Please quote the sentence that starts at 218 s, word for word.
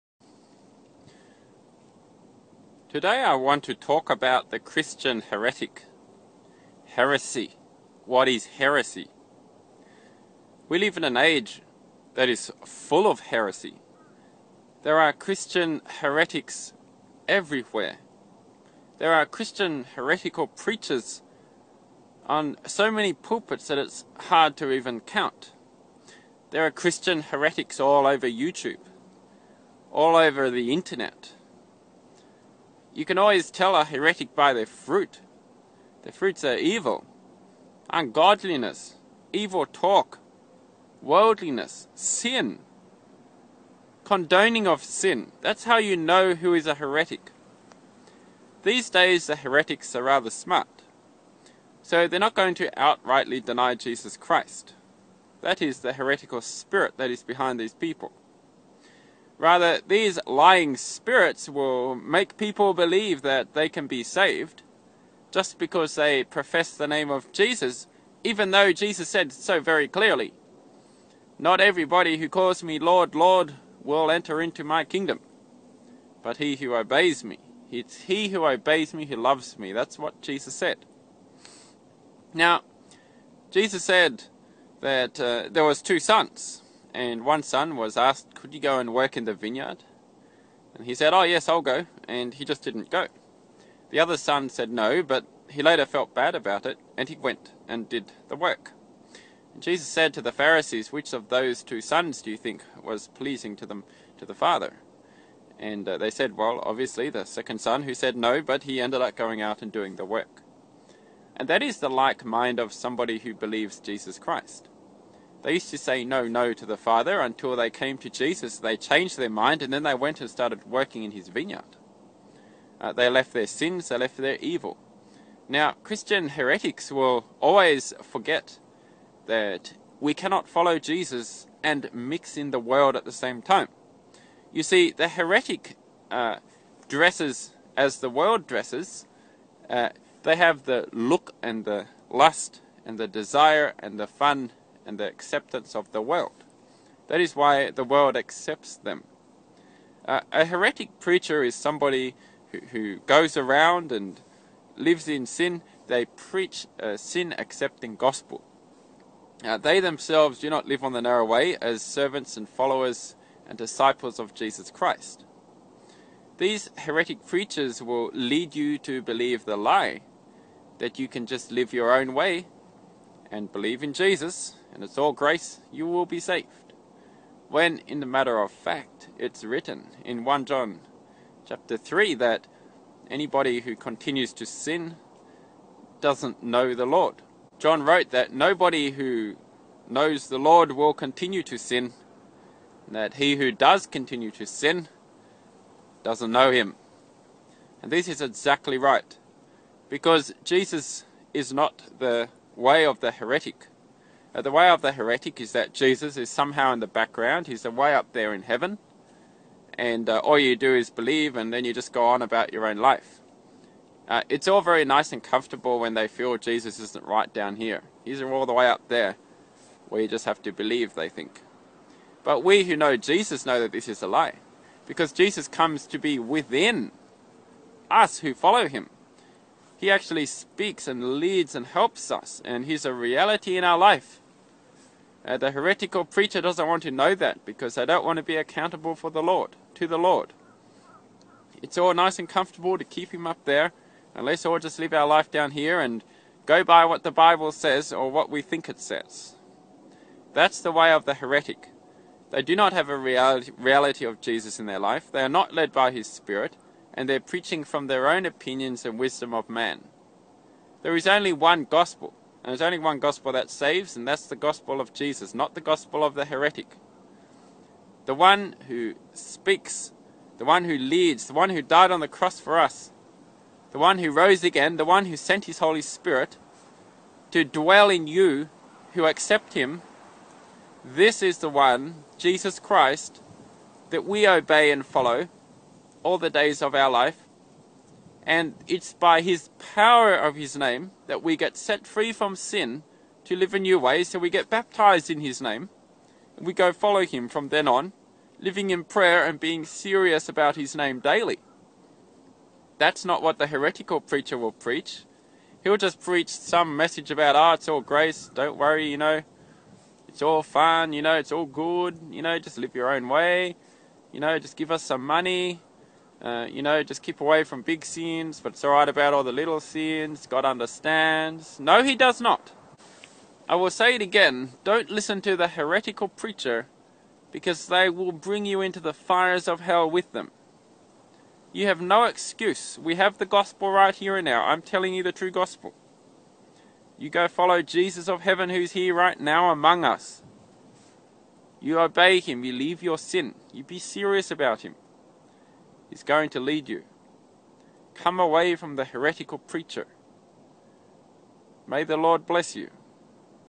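He's all the way up there, where you just have to believe, they think.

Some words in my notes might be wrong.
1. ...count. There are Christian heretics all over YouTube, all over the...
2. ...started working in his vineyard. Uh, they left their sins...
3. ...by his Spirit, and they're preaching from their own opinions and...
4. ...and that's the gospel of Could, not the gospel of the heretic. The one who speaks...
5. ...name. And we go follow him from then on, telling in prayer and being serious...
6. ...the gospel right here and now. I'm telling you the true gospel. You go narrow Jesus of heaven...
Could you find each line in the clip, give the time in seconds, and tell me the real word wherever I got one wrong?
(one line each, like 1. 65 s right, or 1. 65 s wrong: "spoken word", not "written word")
1. 24 s right
2. 120 s right
3. 255 s right
4. 263 s wrong: "Jesus", not "Could"
5. 295 s wrong: "living", not "telling"
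6. 333 s wrong: "follow", not "narrow".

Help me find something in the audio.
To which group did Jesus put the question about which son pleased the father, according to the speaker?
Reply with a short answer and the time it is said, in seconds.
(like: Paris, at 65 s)
the Pharisees, at 100 s.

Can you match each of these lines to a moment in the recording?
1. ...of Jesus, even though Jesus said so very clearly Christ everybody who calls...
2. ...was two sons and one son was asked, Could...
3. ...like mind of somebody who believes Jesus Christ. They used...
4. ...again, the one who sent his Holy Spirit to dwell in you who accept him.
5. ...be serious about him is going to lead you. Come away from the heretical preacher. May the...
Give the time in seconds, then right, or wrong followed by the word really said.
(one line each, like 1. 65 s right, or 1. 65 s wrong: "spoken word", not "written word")
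1. 67 s wrong: "Not", not "Christ"
2. 85 s right
3. 111 s right
4. 274 s right
5. 343 s right.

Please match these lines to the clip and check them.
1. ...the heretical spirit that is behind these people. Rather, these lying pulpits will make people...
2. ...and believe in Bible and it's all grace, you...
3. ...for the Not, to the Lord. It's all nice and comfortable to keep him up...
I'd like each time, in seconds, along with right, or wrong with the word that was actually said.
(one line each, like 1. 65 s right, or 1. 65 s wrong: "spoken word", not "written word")
1. 55 s wrong: "spirits", not "pulpits"
2. 173 s wrong: "Jesus", not "Bible"
3. 238 s wrong: "Lord", not "Not".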